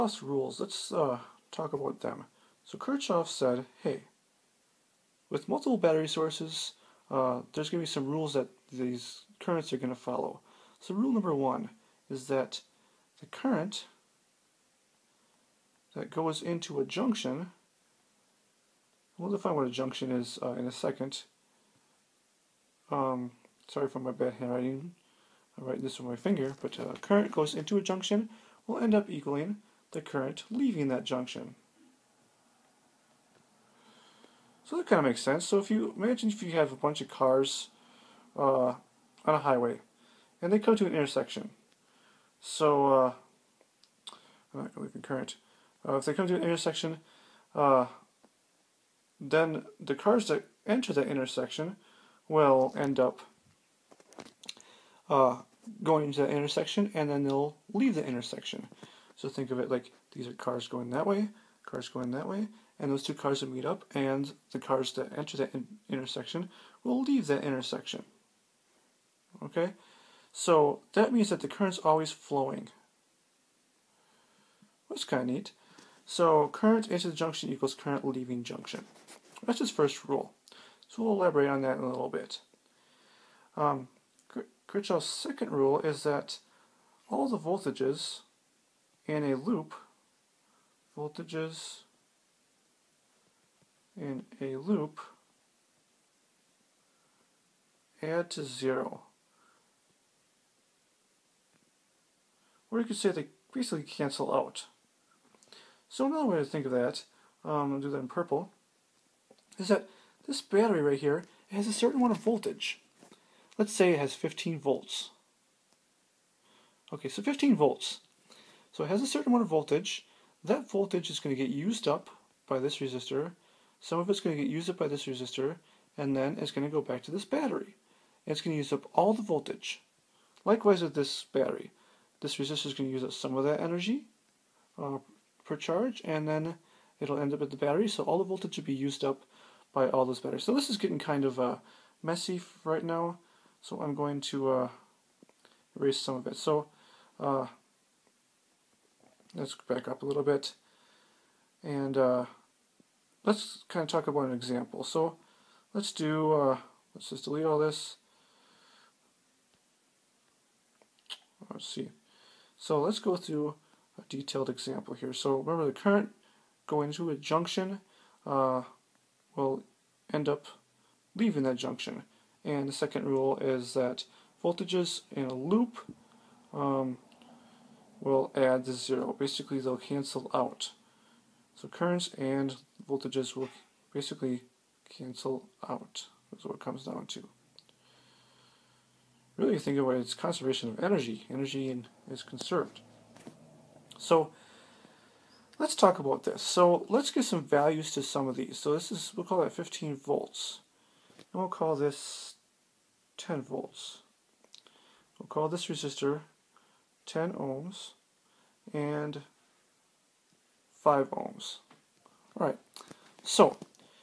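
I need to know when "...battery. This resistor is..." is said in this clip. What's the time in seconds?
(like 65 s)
131 s.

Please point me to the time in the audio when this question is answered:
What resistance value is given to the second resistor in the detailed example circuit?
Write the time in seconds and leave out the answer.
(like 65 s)
210 s.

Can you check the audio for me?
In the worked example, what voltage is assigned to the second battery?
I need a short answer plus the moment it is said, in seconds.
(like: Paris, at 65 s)
10 volts, at 203 s.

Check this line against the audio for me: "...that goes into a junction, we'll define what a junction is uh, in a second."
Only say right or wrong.
right.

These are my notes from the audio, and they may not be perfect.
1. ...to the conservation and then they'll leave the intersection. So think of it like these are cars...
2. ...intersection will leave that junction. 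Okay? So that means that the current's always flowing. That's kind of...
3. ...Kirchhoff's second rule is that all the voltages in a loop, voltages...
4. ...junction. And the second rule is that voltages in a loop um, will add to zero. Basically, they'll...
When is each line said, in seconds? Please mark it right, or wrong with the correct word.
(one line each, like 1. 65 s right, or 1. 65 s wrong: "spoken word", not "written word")
1. 56 s wrong: "intersection", not "conservation"
2. 65 s wrong: "intersection", not "junction"
3. 84 s right
4. 171 s right.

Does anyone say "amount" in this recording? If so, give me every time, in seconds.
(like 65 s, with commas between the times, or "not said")
111 s, 119 s.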